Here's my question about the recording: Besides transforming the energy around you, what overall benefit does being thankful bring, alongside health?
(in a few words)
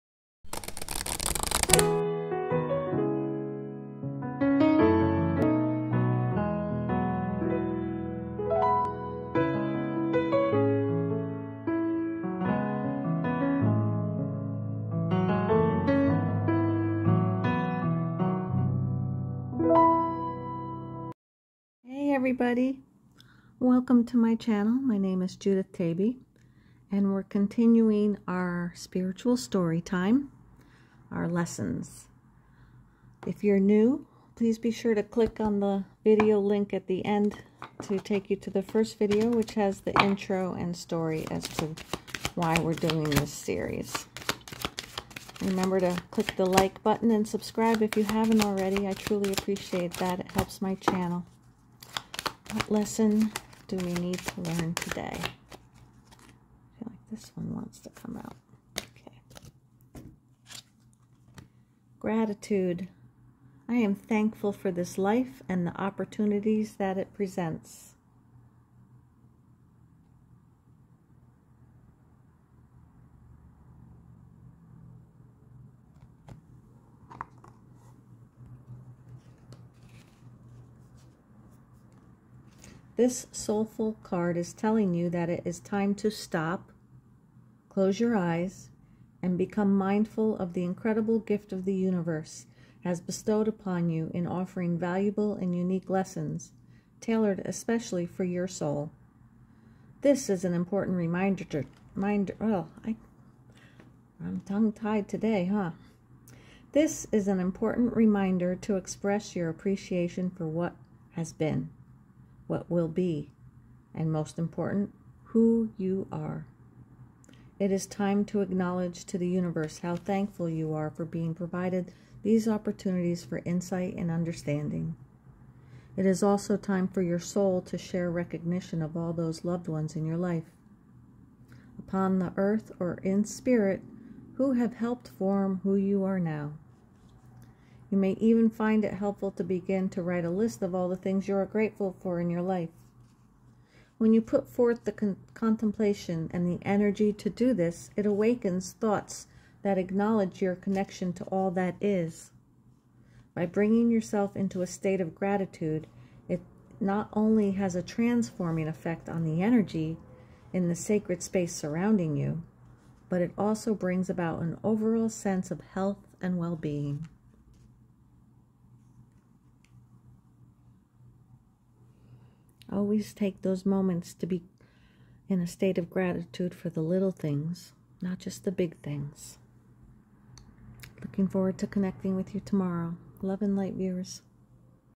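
Well being.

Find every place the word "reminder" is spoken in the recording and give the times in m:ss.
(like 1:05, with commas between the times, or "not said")
1:40, 1:47.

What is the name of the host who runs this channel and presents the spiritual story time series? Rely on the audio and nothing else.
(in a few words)
Judith Taybee.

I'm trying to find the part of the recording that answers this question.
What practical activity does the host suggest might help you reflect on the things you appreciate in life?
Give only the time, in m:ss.
2:20.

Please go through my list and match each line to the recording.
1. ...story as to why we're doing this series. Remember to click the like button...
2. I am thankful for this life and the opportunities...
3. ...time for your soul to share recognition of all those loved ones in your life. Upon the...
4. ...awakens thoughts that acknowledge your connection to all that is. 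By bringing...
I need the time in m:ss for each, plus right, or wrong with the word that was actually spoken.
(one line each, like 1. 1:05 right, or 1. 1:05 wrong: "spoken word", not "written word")
1. 0:40 right
2. 1:03 right
3. 2:06 right
4. 2:28 right.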